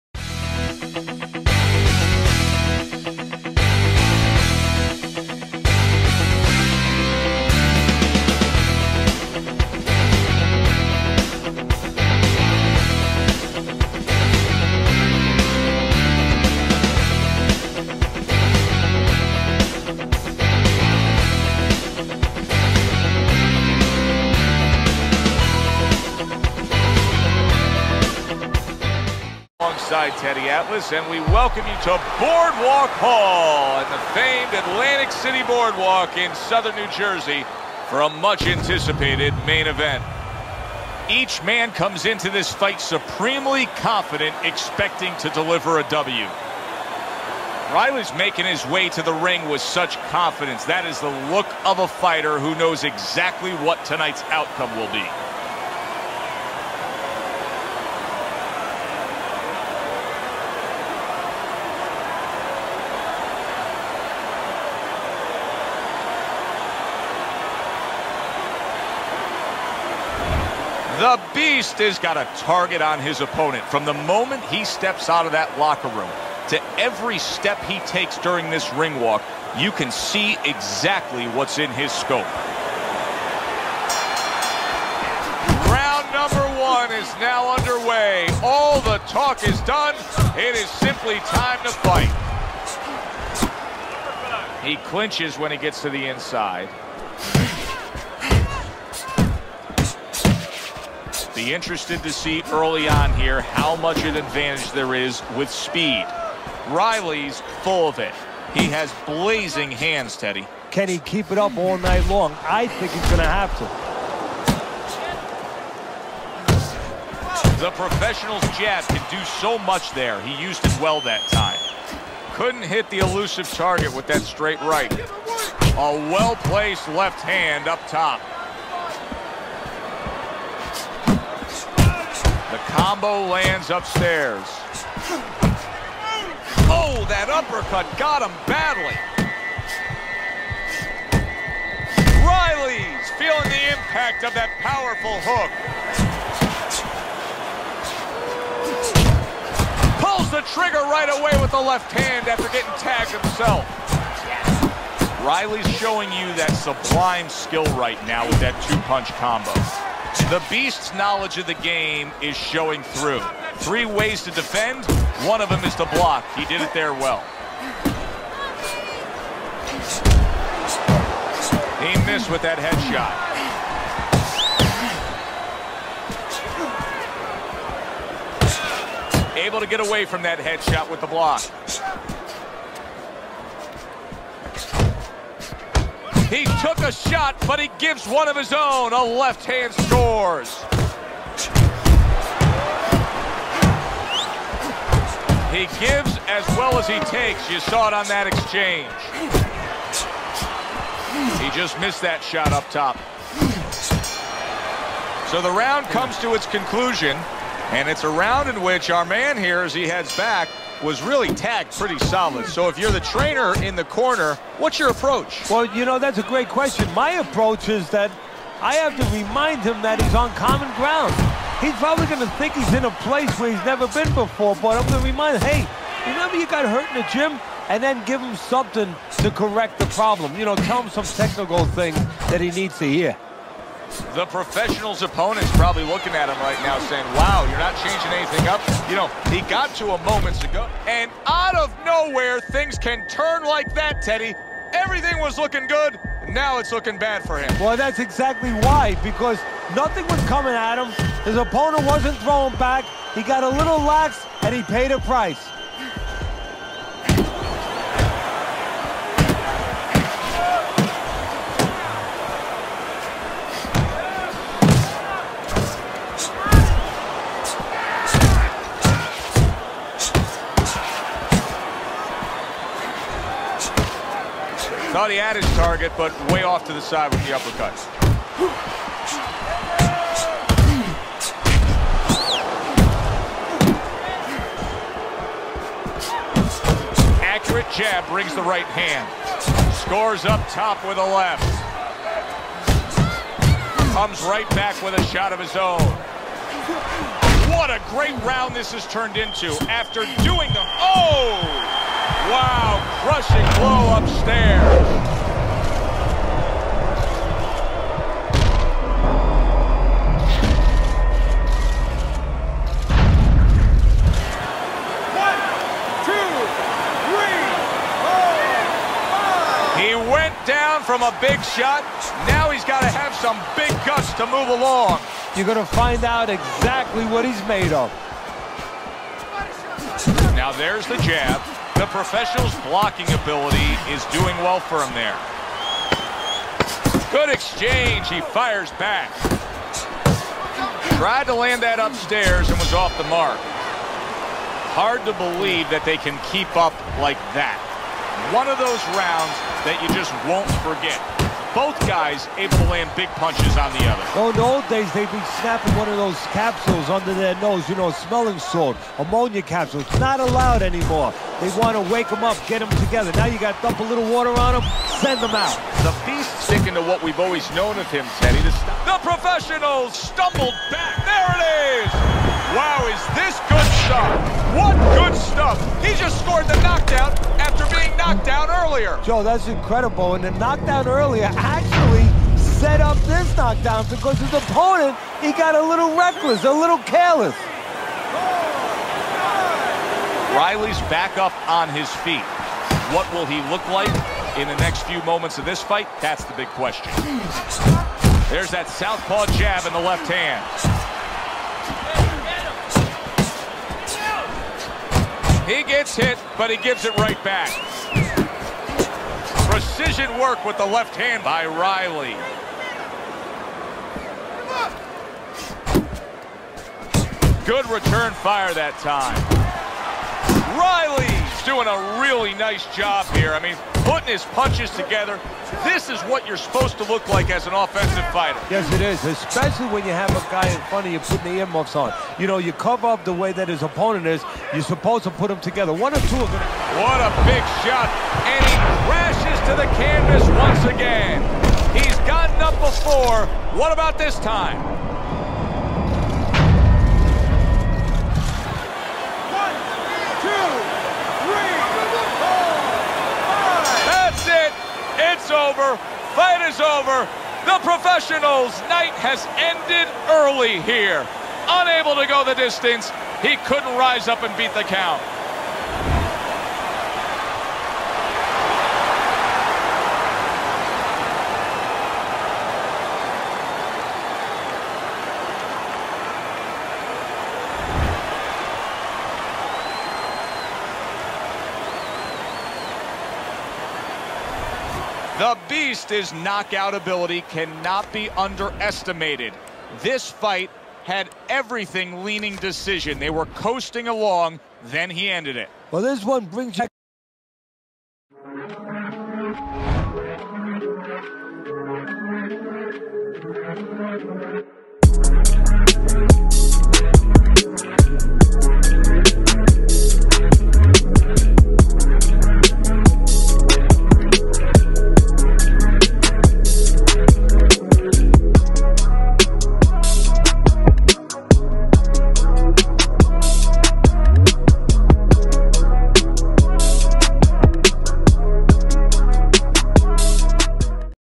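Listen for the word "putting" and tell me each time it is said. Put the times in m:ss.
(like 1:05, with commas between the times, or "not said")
7:03, 7:10.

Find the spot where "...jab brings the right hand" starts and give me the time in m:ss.
4:47.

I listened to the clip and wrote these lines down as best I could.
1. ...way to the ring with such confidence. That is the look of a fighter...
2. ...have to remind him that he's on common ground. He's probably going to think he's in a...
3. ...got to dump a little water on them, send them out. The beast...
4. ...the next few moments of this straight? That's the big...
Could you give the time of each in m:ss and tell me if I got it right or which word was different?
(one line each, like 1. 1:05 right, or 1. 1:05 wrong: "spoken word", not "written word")
1. 0:48 right
2. 3:38 right
3. 6:03 right
4. 6:34 wrong: "fight", not "straight".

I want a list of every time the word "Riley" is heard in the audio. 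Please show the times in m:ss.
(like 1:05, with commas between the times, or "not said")
0:47, 1:46, 2:22, 2:35, 6:30, 6:51, 7:00.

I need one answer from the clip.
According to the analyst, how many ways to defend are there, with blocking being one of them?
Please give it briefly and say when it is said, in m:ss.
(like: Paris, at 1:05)
3, at 2:43.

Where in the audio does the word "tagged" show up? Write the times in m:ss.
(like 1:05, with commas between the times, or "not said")
2:32, 3:31.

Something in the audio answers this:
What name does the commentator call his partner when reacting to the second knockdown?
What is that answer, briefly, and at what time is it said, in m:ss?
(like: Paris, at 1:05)
Joe, at 6:19.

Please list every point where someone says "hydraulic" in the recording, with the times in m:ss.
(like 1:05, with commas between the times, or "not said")
not said.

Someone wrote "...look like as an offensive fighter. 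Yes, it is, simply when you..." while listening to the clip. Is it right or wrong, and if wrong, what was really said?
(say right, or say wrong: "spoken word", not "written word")
wrong: "especially", not "simply".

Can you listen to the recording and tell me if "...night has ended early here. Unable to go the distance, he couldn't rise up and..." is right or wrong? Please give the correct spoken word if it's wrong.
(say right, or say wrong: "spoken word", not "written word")
right.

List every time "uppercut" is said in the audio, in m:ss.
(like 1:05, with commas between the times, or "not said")
2:17, 4:37.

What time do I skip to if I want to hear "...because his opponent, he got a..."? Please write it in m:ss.
6:23.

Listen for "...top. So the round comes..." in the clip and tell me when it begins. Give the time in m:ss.
3:22.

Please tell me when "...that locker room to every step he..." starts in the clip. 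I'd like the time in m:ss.
1:15.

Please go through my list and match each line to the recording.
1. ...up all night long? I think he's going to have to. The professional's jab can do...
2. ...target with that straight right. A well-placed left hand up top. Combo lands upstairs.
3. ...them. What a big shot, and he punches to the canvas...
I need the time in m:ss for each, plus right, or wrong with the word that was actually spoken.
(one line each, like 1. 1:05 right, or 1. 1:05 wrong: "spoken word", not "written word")
1. 1:51 right
2. 2:03 right
3. 7:16 wrong: "crashes", not "punches".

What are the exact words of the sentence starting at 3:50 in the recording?
You know, tell him some technical thing that he needs to hear.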